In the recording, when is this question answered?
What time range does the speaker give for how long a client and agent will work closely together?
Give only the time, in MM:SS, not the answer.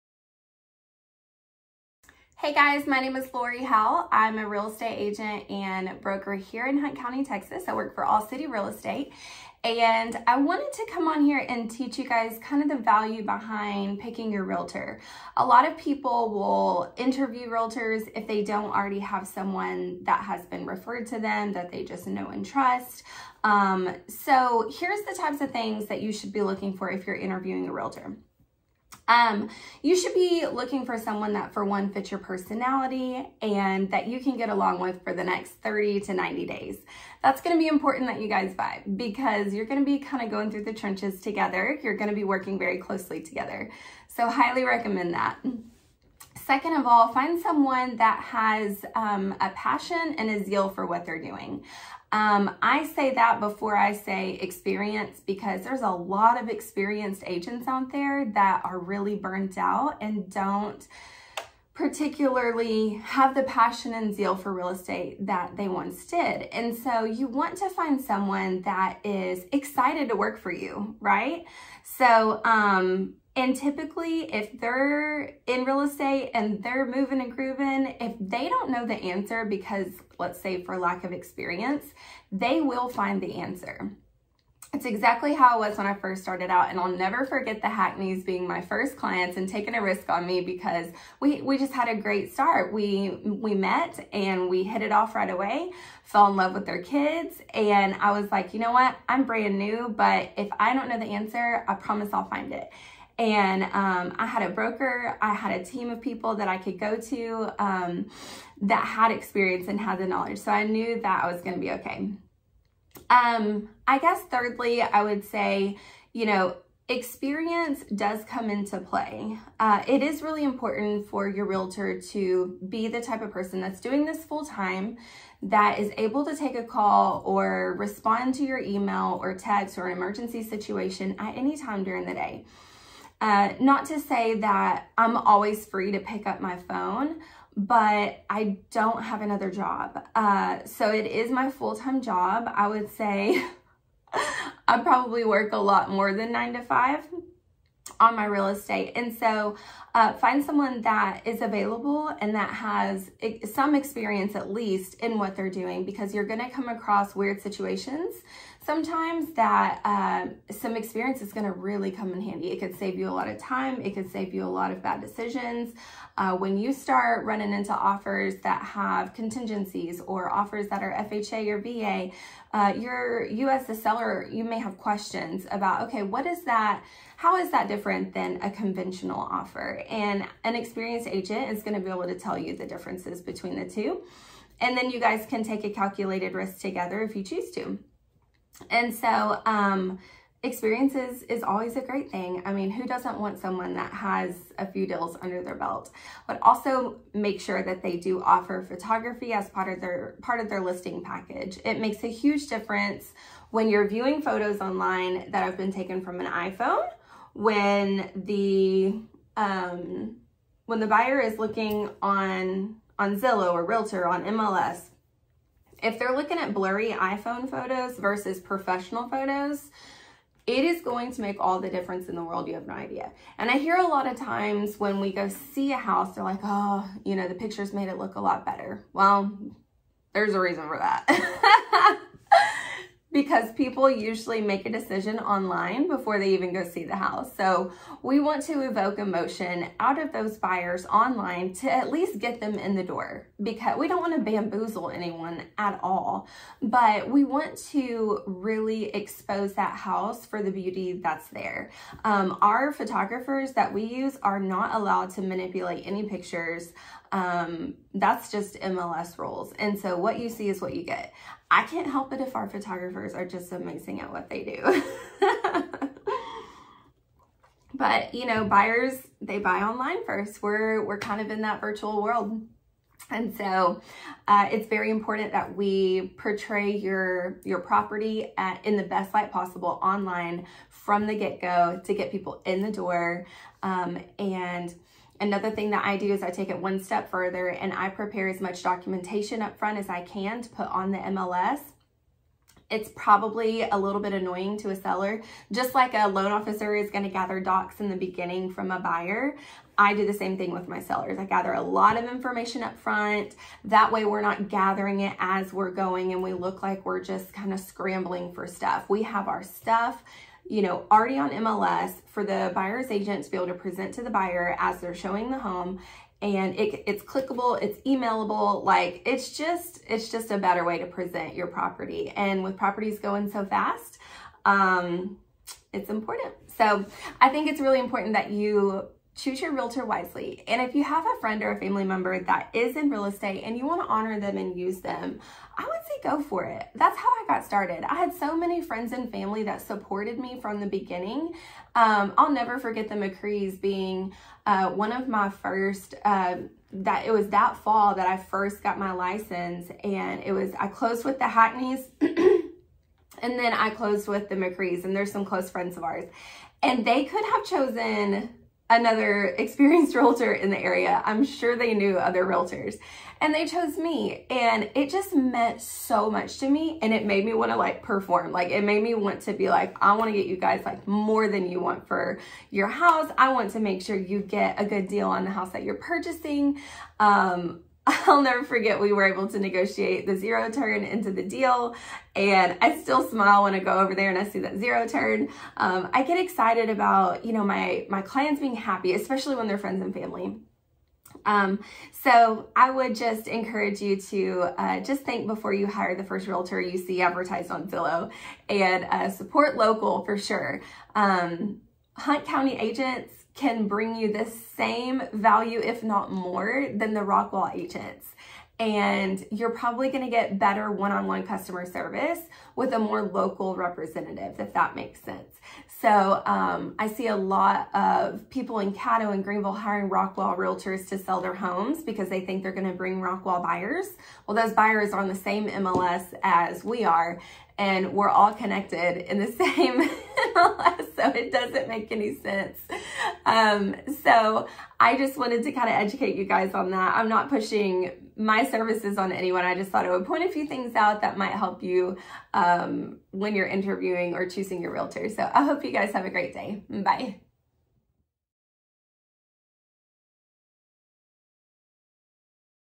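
00:35.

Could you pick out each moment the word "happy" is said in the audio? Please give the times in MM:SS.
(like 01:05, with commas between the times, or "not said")
06:28.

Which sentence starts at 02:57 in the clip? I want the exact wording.
How is that different than a conventional offer?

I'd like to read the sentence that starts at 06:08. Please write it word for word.
Like it made me want to be like, I want to get you guys like more than you want for your house.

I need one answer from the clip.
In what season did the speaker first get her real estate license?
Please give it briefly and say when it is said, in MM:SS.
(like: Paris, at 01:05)
Fall, at 05:47.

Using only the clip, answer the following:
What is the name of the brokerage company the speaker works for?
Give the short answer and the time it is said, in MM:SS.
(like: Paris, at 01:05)
All City Real Estate, at 00:08.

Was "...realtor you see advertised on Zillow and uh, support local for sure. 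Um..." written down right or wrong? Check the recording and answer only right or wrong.
right.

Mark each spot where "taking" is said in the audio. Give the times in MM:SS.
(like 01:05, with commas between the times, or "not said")
01:29.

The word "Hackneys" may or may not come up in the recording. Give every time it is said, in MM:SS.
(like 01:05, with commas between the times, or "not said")
01:27, 05:51.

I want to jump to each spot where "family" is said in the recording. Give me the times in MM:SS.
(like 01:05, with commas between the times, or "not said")
05:31, 05:39, 06:29.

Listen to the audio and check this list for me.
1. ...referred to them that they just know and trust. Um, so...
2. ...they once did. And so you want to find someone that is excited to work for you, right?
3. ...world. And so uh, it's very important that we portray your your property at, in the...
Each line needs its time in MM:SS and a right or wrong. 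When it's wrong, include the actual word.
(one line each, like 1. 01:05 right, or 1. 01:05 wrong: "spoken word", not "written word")
1. 00:20 right
2. 01:05 right
3. 04:32 right.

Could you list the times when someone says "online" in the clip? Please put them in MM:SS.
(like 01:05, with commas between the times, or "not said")
03:24, 03:55, 04:00, 04:29, 04:39.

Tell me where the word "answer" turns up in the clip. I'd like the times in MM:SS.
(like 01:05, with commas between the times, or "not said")
01:18, 01:23, 01:41.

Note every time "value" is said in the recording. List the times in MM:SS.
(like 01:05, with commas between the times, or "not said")
00:12, 06:45.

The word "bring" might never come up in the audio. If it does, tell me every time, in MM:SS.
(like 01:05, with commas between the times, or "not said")
06:43, 07:02.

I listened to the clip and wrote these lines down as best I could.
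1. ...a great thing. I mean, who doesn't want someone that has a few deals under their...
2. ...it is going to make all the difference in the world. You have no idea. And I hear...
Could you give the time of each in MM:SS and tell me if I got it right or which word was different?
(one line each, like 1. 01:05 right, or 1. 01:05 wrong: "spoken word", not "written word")
1. 03:11 right
2. 03:40 right.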